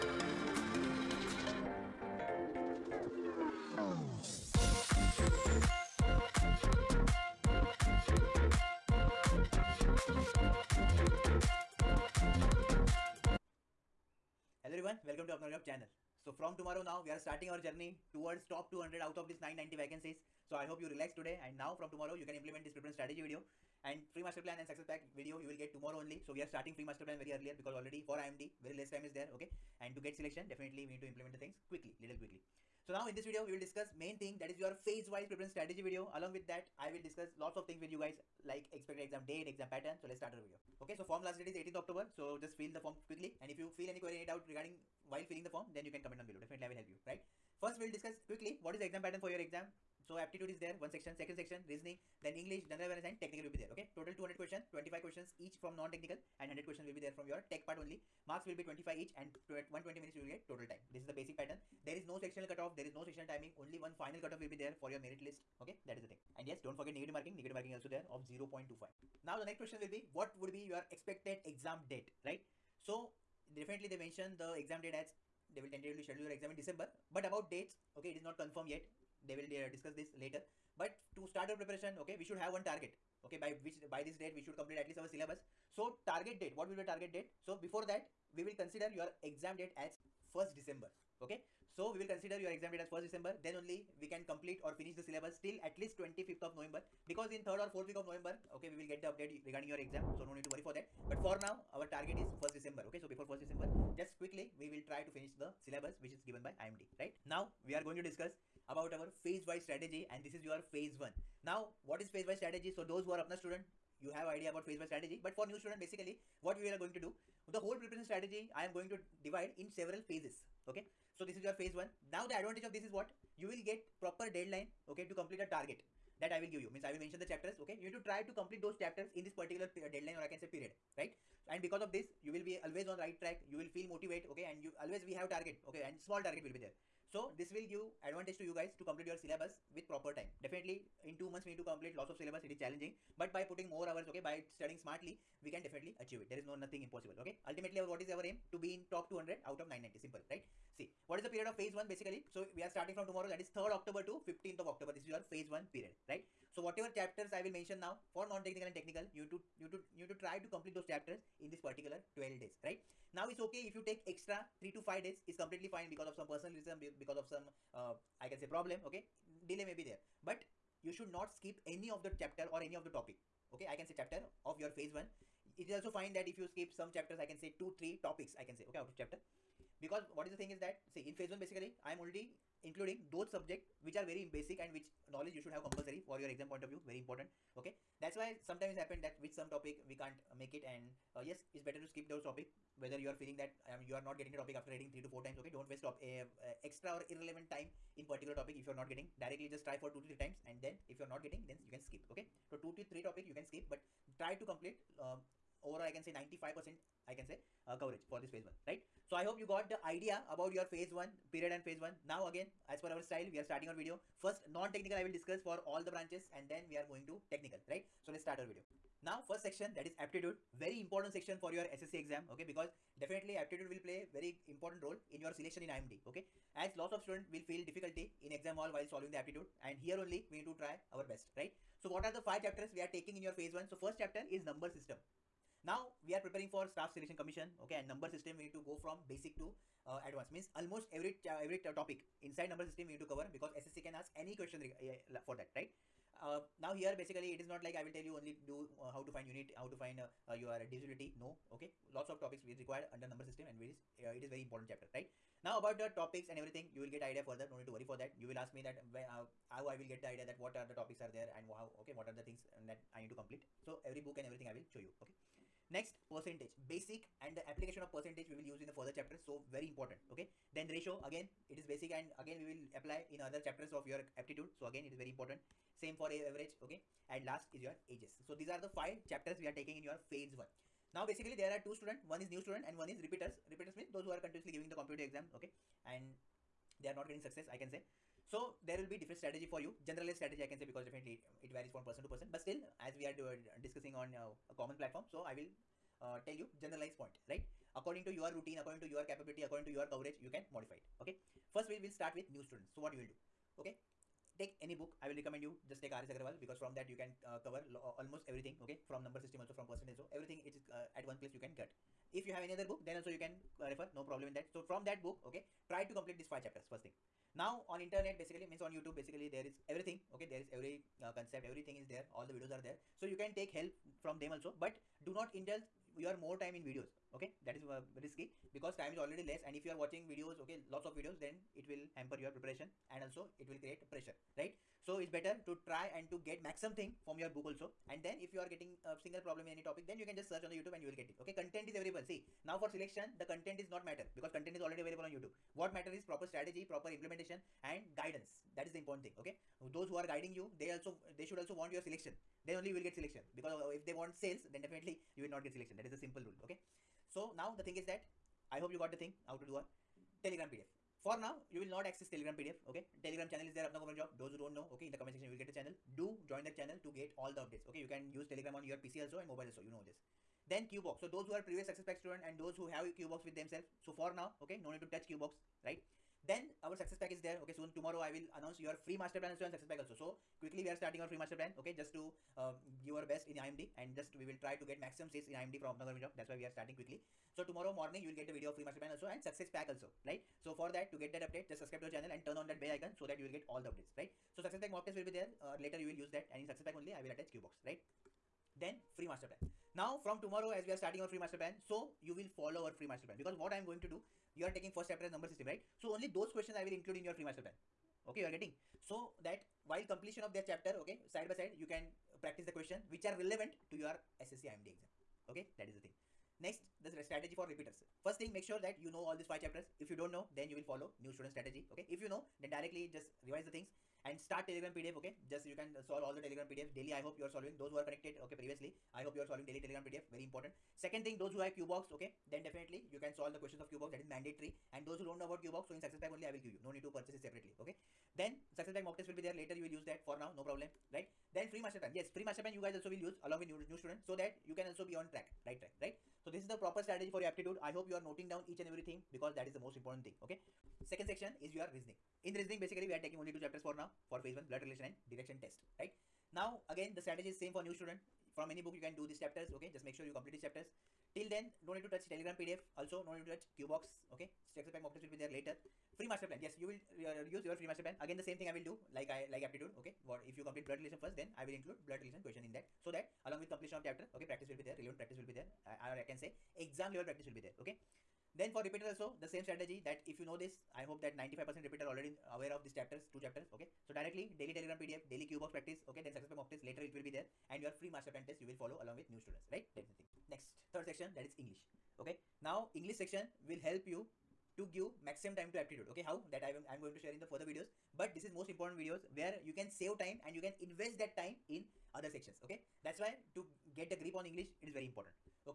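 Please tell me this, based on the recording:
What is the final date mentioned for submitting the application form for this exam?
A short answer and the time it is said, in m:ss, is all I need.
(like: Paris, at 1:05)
18th October, at 0:41.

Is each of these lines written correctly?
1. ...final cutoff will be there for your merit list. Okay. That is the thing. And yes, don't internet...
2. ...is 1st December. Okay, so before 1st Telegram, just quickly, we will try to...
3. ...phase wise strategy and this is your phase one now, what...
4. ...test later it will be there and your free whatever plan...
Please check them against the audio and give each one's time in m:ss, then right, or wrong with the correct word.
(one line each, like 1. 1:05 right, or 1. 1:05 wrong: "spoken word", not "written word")
1. 1:03 wrong: "forget", not "internet"
2. 1:42 wrong: "December", not "Telegram"
3. 1:49 right
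4. 8:06 wrong: "master", not "whatever".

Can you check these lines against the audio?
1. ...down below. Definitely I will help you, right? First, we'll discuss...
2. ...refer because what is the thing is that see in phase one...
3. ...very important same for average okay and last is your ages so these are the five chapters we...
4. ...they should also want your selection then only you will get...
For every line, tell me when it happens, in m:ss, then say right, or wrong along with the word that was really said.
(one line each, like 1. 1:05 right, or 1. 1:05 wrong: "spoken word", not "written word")
1. 0:46 right
2. 2:58 wrong: "chapter", not "refer"
3. 4:34 right
4. 5:51 right.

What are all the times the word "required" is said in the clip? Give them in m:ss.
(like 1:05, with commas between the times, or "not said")
4:12.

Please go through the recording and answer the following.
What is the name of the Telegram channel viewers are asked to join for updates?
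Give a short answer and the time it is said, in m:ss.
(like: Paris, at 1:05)
apna common job, at 6:03.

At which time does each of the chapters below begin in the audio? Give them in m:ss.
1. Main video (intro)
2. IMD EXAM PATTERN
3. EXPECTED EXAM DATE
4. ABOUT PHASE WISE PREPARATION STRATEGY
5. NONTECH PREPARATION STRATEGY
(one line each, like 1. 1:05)
1. 0:29
2. 0:40
3. 1:09
4. 1:47
5. 3:38.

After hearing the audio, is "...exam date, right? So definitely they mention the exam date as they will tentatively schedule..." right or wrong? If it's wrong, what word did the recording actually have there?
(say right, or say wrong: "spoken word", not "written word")
right.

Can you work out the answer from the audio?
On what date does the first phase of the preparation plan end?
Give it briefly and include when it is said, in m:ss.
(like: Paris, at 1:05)
15th of October, at 2:34.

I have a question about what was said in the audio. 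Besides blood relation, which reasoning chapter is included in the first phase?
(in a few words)
direction test.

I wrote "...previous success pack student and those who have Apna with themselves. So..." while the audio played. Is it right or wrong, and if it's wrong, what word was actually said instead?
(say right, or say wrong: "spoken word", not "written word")
wrong: "QBox", not "Apna".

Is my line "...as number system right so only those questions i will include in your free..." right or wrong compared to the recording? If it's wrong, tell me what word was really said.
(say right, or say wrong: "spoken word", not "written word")
right.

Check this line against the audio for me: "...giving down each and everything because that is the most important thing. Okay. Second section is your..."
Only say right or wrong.
wrong.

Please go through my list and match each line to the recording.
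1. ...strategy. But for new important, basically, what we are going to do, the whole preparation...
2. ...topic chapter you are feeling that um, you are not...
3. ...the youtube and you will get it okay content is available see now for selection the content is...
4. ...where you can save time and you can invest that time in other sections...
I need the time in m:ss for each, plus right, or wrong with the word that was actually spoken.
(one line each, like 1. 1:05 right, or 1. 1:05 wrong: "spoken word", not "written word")
1. 1:54 wrong: "student", not "important"
2. 3:12 wrong: "whether", not "chapter"
3. 5:40 right
4. 8:19 right.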